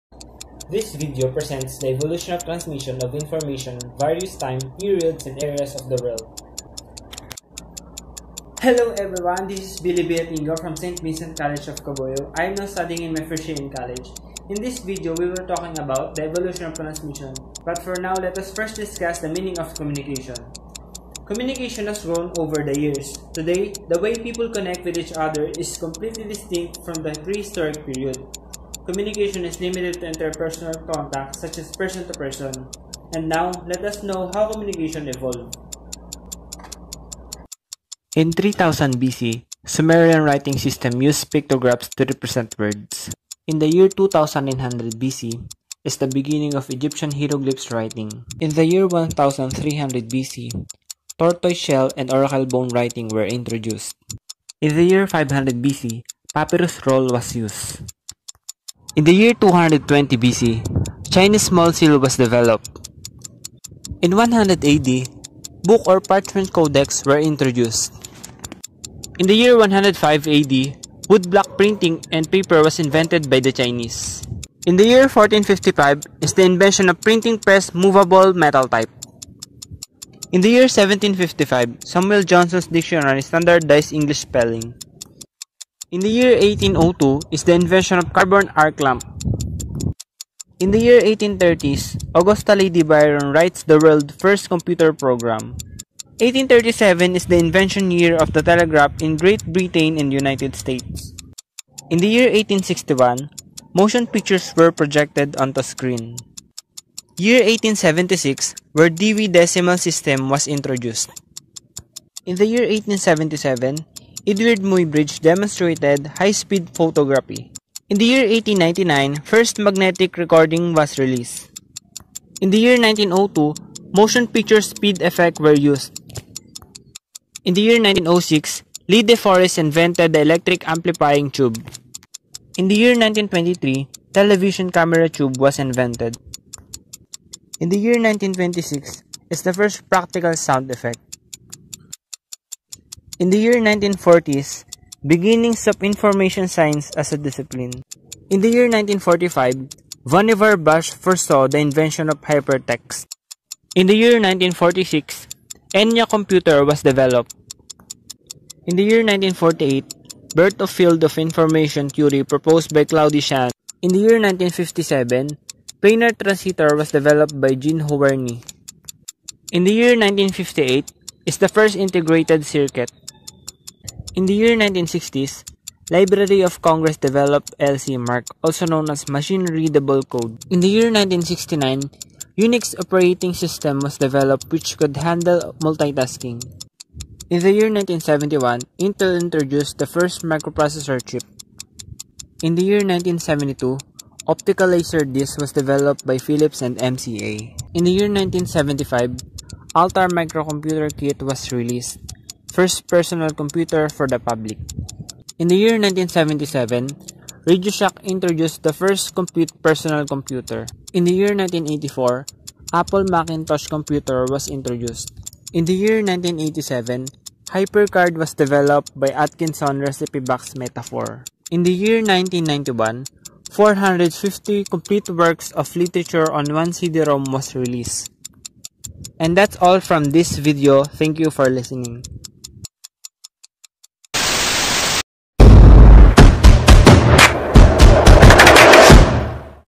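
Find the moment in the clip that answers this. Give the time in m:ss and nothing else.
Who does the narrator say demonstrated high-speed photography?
1:54.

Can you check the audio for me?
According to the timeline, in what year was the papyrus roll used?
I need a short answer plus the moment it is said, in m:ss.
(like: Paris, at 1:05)
500 BC, at 0:55.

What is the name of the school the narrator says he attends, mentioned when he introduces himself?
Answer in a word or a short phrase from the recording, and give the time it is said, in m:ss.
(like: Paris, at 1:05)
St. Vincent College of Cabuyao, at 0:10.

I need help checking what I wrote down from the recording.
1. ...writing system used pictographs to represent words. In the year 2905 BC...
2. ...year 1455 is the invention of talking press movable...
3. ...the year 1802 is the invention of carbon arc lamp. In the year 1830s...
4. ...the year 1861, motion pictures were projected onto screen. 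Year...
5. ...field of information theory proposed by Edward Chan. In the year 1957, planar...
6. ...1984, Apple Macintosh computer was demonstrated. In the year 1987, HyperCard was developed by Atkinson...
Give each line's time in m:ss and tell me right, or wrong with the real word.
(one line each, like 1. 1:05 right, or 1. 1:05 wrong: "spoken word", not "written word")
1. 0:40 wrong: "2900", not "2905"
2. 1:14 wrong: "printing", not "talking"
3. 1:25 right
4. 1:41 right
5. 2:40 wrong: "Claude", not "Edward"
6. 3:31 wrong: "introduced", not "demonstrated".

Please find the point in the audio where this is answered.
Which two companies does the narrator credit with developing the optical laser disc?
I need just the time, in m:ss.
3:16.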